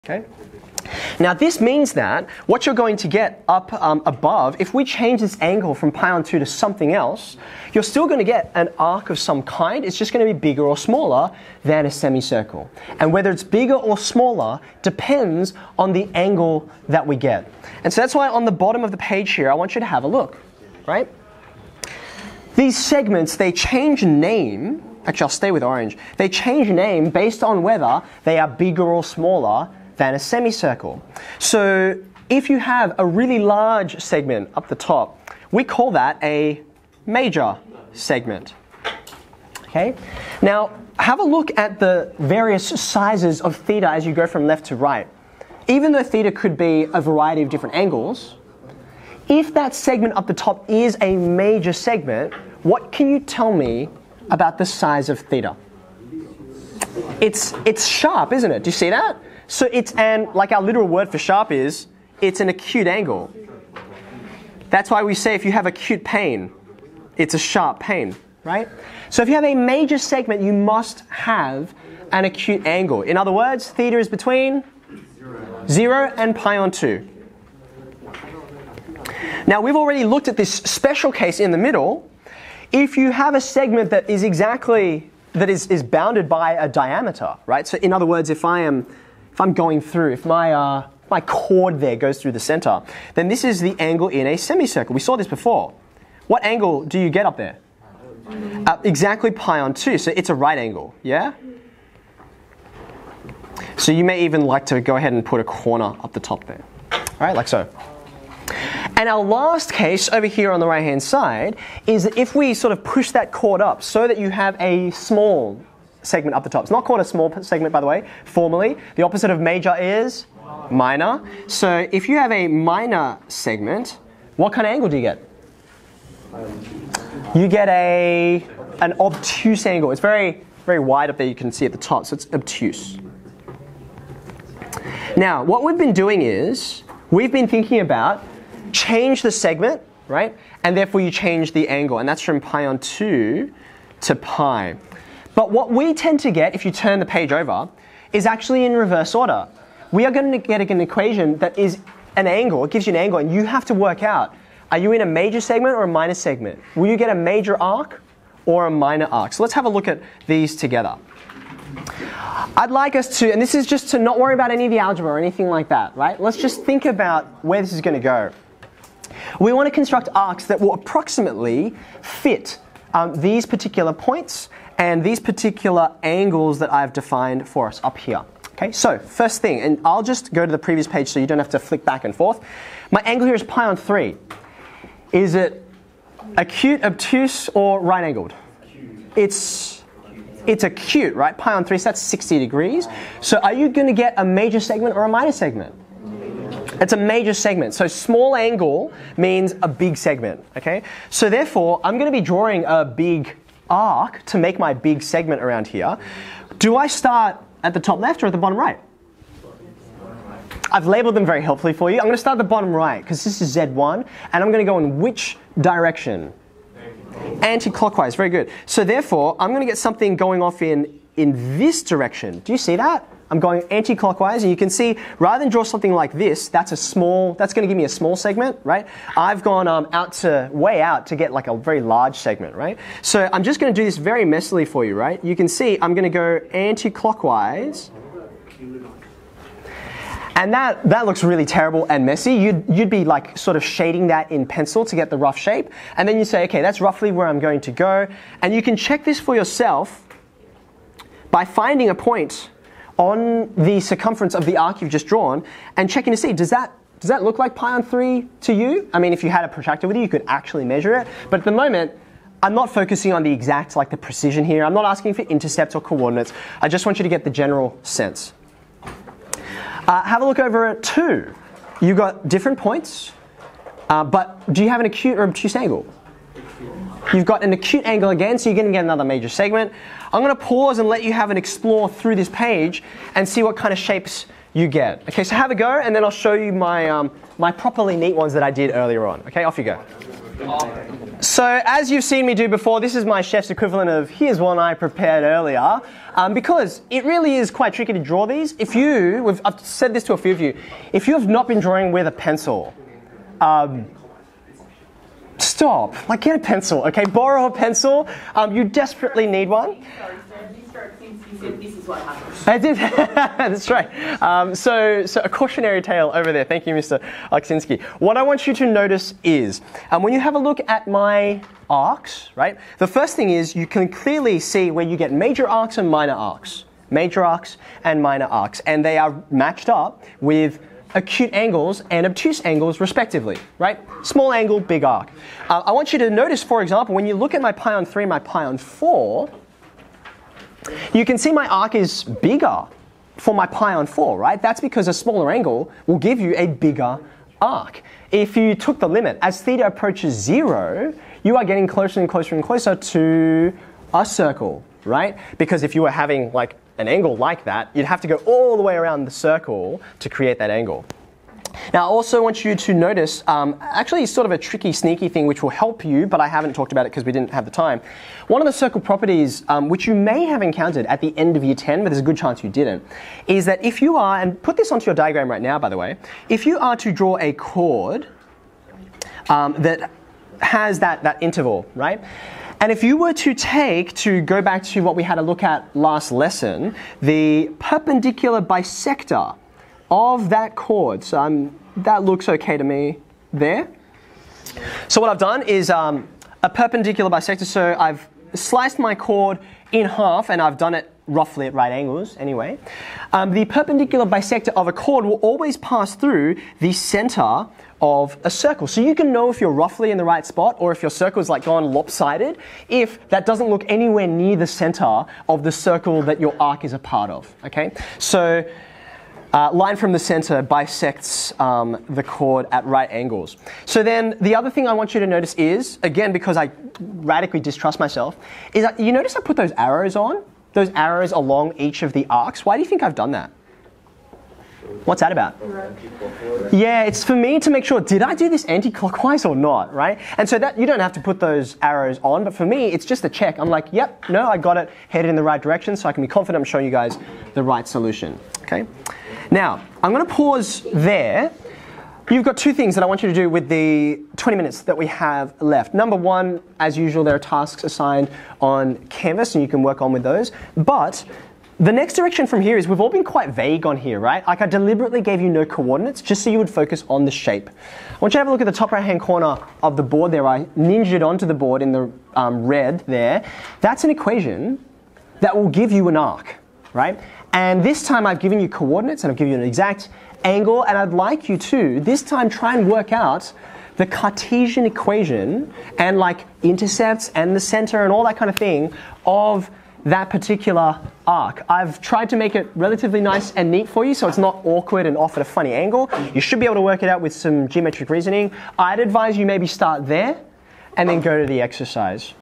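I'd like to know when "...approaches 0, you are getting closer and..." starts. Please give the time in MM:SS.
05:49.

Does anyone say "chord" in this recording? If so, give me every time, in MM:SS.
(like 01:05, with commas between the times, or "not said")
01:31, 01:53, 06:17, 06:30, 06:38, 06:44, 07:02.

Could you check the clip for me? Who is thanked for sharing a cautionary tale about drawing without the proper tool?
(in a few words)
Mr. Aleksinski.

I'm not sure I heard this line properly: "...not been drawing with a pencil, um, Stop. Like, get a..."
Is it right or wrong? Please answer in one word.
right.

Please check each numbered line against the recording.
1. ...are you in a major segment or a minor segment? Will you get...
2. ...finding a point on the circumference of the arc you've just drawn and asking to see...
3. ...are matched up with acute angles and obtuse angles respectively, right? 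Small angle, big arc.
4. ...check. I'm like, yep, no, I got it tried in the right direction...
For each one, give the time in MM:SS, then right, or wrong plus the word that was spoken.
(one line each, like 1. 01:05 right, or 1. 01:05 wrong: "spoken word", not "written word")
1. 02:34 right
2. 04:11 wrong: "checking", not "asking"
3. 05:28 right
4. 07:23 wrong: "headed", not "tried".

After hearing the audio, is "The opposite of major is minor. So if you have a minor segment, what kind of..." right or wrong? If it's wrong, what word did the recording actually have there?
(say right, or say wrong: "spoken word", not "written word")
right.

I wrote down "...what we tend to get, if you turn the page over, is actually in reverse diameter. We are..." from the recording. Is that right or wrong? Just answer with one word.
wrong.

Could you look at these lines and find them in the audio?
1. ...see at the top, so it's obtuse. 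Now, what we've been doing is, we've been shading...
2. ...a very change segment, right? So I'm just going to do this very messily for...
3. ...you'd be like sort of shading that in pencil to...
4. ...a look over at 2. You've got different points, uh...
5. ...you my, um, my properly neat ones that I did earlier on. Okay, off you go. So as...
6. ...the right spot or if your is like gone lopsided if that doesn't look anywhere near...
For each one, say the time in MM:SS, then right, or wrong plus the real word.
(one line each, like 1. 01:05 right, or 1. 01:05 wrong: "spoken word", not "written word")
1. 02:11 wrong: "thinking", not "shading"
2. 03:51 wrong: "large", not "change"
3. 04:02 right
4. 04:30 right
5. 04:46 right
6. 06:49 right.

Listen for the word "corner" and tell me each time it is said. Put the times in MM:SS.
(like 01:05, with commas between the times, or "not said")
01:45, 07:48.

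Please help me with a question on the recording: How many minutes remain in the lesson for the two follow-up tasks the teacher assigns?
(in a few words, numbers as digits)
20.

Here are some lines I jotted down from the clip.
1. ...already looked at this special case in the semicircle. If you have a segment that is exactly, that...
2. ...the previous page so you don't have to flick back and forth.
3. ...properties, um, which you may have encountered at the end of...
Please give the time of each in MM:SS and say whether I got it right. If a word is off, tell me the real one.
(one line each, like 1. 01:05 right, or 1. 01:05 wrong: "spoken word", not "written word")
1. 01:19 wrong: "middle", not "semicircle"
2. 03:00 right
3. 06:08 right.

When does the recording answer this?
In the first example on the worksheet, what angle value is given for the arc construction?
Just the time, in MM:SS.
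03:11.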